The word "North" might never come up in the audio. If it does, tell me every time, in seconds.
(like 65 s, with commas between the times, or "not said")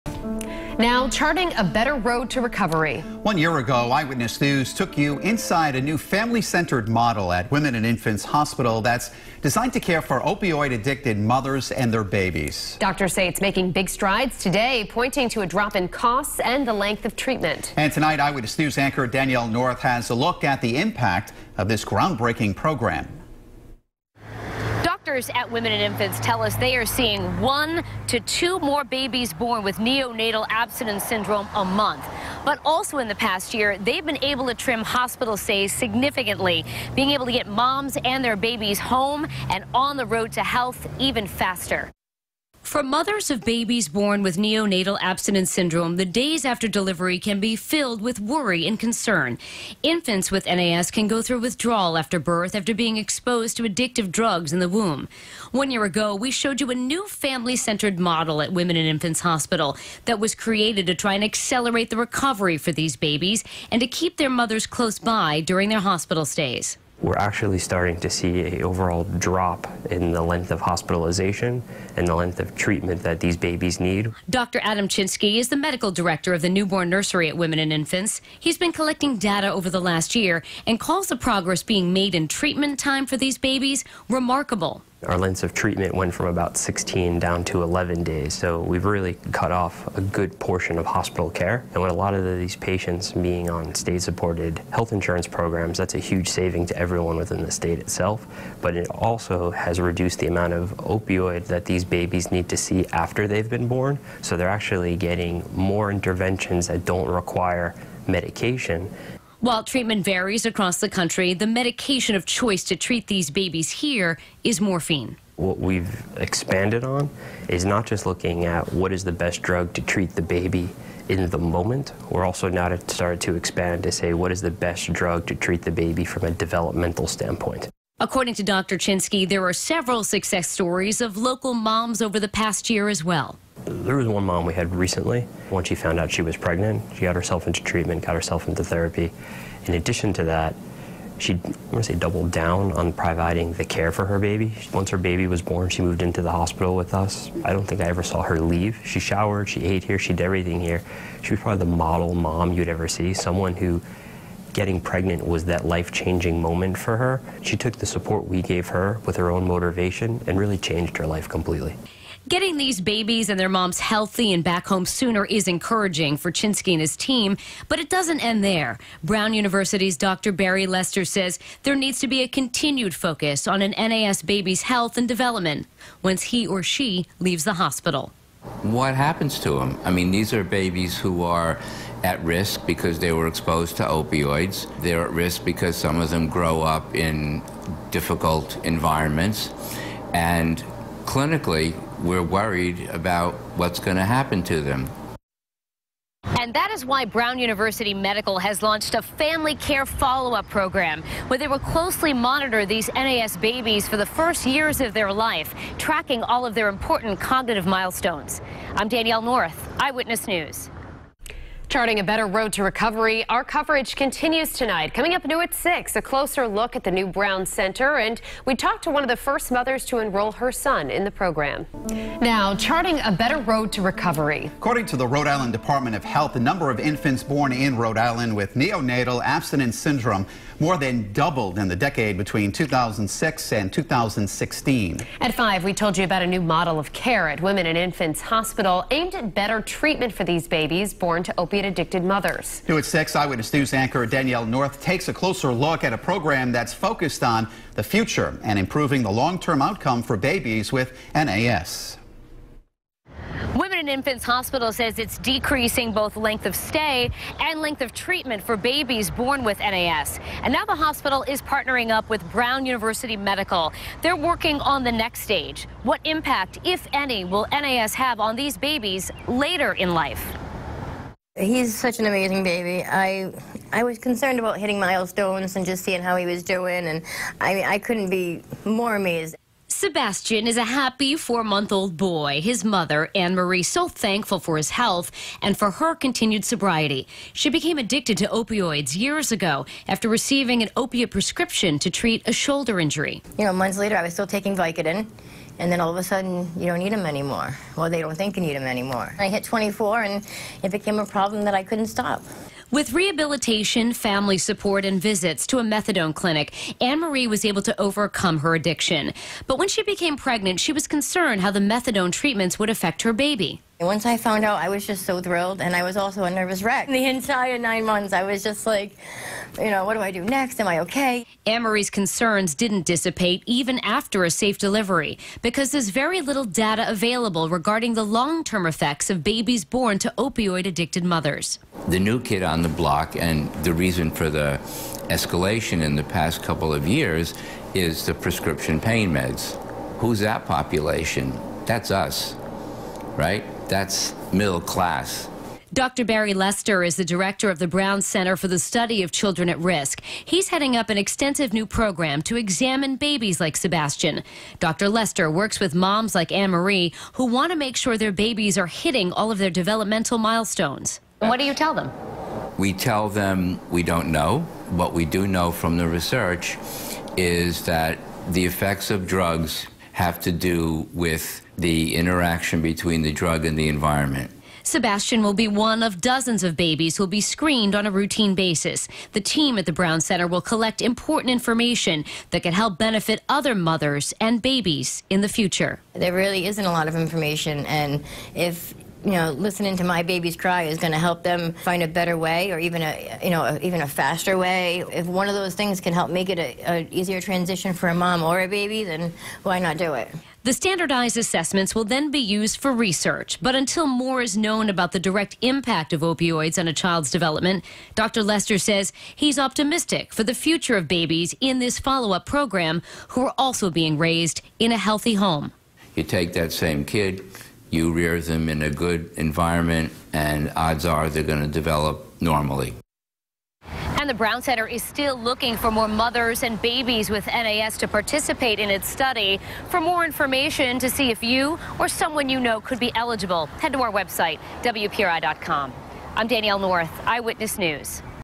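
19 s, 209 s, 244 s, 436 s.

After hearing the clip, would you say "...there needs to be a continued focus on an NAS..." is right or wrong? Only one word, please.
right.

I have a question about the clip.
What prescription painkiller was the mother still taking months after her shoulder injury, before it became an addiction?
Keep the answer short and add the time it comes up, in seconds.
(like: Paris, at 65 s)
Vicodin, at 294 s.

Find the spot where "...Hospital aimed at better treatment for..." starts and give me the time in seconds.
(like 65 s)
238 s.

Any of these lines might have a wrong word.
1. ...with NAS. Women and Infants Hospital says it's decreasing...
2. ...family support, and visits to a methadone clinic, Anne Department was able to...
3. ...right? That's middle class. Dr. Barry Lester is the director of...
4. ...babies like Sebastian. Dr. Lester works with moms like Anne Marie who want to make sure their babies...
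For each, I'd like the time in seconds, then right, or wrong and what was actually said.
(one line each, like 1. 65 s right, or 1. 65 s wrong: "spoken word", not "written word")
1. 250 s right
2. 303 s wrong: "Marie", not "Department"
3. 343 s right
4. 352 s right.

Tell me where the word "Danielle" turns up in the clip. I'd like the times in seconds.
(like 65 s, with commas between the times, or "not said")
19 s, 208 s, 244 s, 436 s.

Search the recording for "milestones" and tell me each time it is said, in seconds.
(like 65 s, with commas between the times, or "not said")
207 s, 274 s, 360 s.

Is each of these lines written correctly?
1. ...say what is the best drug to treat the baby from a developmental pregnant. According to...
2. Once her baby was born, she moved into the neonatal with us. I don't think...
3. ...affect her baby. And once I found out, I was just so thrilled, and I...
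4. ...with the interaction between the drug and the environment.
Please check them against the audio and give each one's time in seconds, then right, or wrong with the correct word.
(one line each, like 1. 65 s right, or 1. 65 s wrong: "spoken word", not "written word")
1. 123 s wrong: "standpoint", not "pregnant"
2. 144 s wrong: "hospital", not "neonatal"
3. 312 s right
4. 370 s right.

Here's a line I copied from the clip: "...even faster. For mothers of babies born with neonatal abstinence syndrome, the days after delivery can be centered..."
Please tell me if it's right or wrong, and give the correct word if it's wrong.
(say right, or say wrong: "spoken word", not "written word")
wrong: "filled", not "centered".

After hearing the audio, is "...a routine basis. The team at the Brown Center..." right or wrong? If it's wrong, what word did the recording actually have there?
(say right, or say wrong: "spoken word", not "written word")
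right.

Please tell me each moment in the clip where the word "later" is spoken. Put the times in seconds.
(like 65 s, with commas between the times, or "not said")
269 s, 293 s.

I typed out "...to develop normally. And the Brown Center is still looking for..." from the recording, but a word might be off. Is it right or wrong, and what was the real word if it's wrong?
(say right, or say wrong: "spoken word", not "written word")
right.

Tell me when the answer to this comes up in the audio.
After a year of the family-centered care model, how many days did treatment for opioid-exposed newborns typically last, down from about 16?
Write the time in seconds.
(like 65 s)
87 s.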